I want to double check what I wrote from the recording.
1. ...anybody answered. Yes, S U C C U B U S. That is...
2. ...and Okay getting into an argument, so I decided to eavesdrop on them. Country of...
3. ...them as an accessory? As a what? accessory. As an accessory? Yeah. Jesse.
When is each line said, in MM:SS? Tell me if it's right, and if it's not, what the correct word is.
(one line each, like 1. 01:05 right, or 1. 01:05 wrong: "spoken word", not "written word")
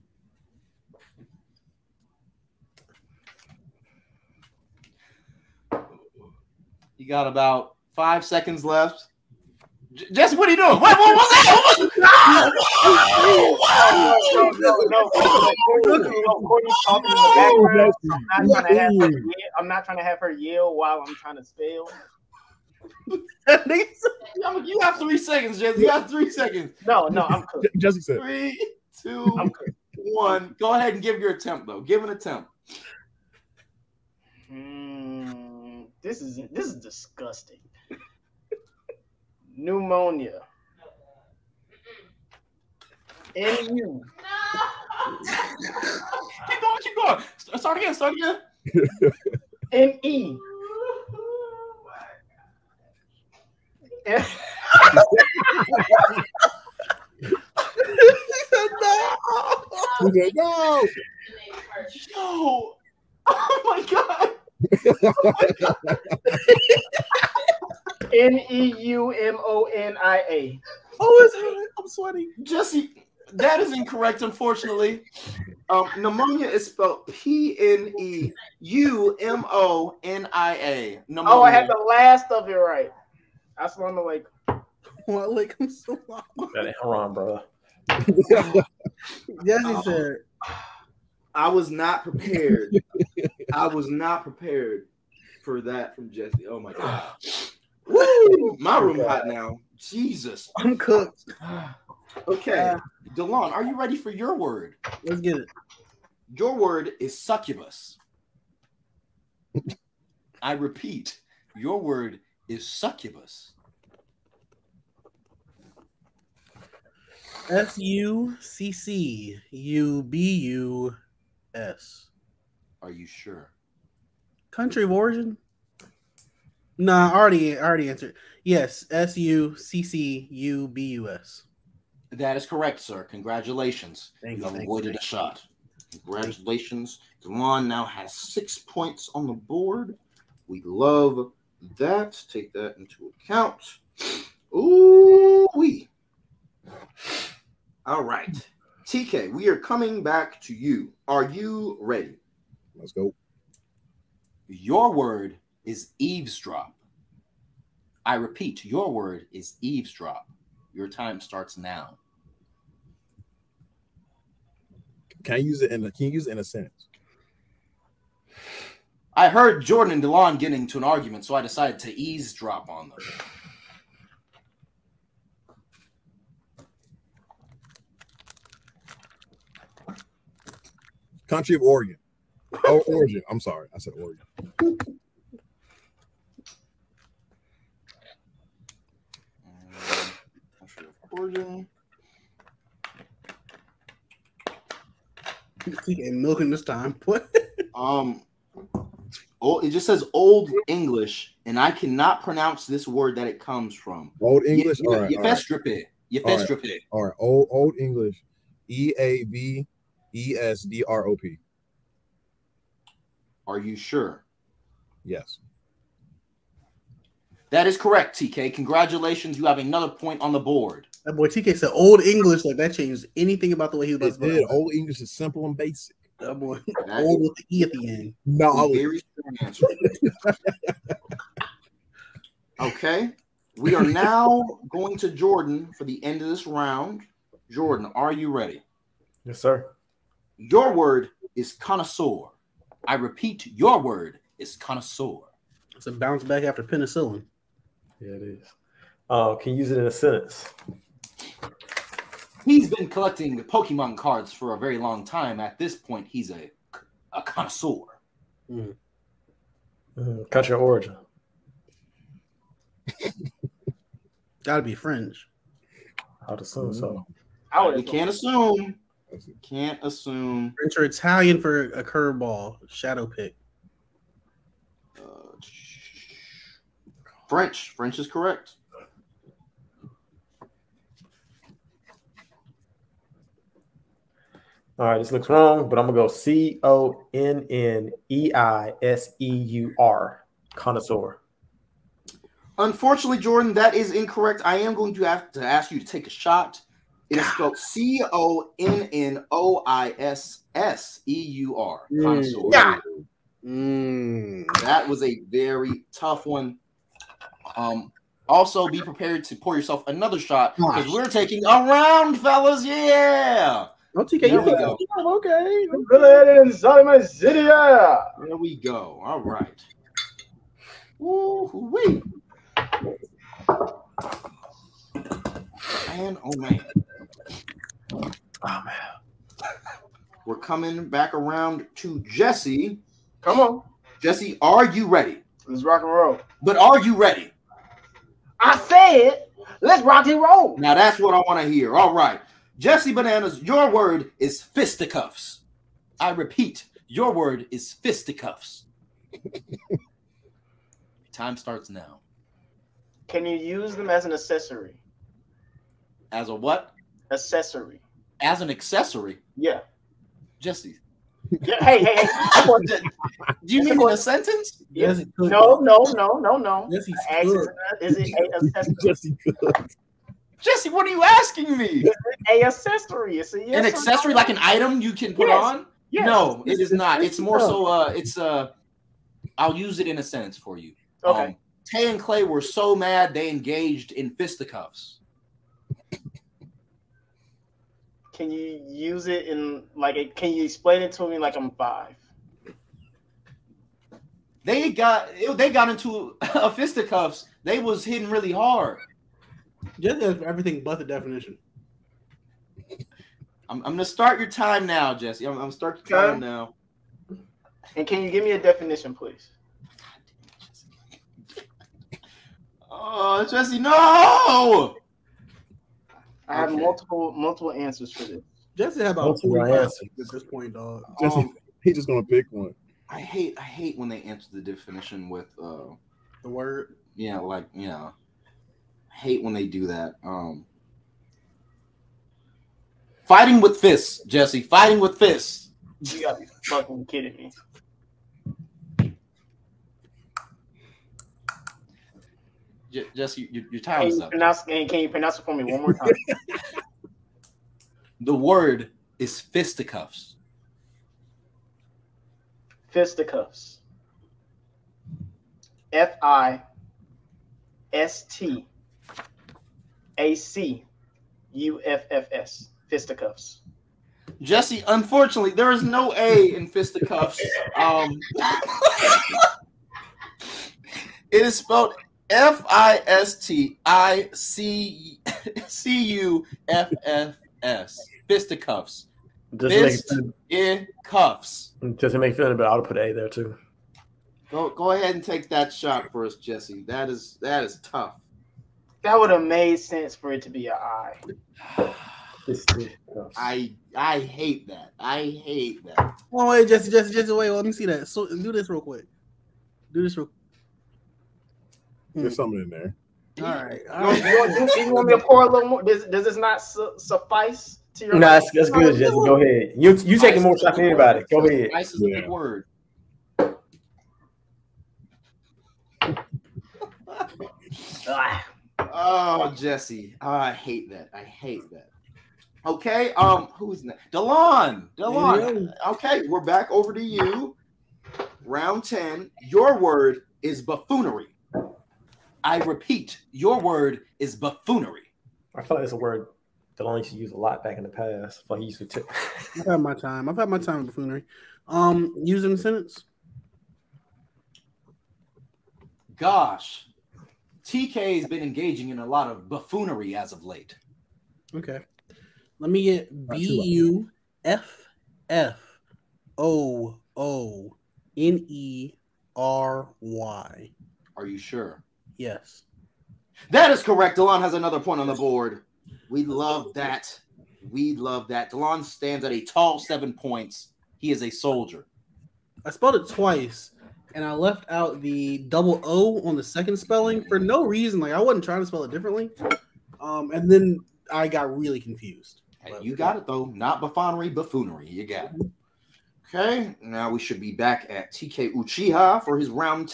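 1. 02:07 wrong: "already", not "anybody"
2. 02:49 wrong: "Delon", not "Okay"
3. 05:53 right.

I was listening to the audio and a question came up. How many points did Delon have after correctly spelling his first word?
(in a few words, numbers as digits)
6.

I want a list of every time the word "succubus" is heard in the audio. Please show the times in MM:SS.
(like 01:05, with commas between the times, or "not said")
01:47, 01:52.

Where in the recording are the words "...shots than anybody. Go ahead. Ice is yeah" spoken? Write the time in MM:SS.
08:30.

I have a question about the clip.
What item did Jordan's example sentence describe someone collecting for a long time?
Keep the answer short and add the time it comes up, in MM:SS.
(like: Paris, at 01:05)
Pokemon cards, at 04:13.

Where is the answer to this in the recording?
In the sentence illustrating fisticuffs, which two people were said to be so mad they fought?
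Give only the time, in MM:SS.
06:21.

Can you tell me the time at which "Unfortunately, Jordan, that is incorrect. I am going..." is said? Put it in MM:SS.
04:52.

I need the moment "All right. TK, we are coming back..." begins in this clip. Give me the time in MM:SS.
02:27.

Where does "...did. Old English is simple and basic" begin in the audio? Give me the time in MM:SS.
03:44.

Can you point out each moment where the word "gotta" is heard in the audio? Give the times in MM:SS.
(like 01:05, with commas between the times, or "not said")
04:24, 07:16.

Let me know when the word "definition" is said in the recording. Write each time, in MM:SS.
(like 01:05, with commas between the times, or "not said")
06:40, 06:48, 07:04.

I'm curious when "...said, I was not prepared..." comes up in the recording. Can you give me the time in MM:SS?
01:29.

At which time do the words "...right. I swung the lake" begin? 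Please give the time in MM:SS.
01:22.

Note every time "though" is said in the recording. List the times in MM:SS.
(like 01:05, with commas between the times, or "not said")
00:31, 09:43.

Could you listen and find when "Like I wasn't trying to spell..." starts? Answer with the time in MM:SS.
09:37.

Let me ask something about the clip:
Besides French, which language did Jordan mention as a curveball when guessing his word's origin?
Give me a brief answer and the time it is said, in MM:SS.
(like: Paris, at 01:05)
Italian, at 04:30.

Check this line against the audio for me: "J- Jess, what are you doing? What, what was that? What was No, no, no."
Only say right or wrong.
right.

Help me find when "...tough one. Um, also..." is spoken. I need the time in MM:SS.
05:05.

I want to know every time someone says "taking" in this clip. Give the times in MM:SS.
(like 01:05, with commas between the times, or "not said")
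05:11, 08:29.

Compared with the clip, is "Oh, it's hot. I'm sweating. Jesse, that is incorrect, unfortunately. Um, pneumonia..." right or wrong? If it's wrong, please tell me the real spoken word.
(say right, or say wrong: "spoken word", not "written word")
right.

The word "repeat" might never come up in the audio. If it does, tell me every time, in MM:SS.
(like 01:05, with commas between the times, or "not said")
01:50, 02:38, 04:02, 05:46, 08:52.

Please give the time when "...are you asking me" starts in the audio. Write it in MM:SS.
06:10.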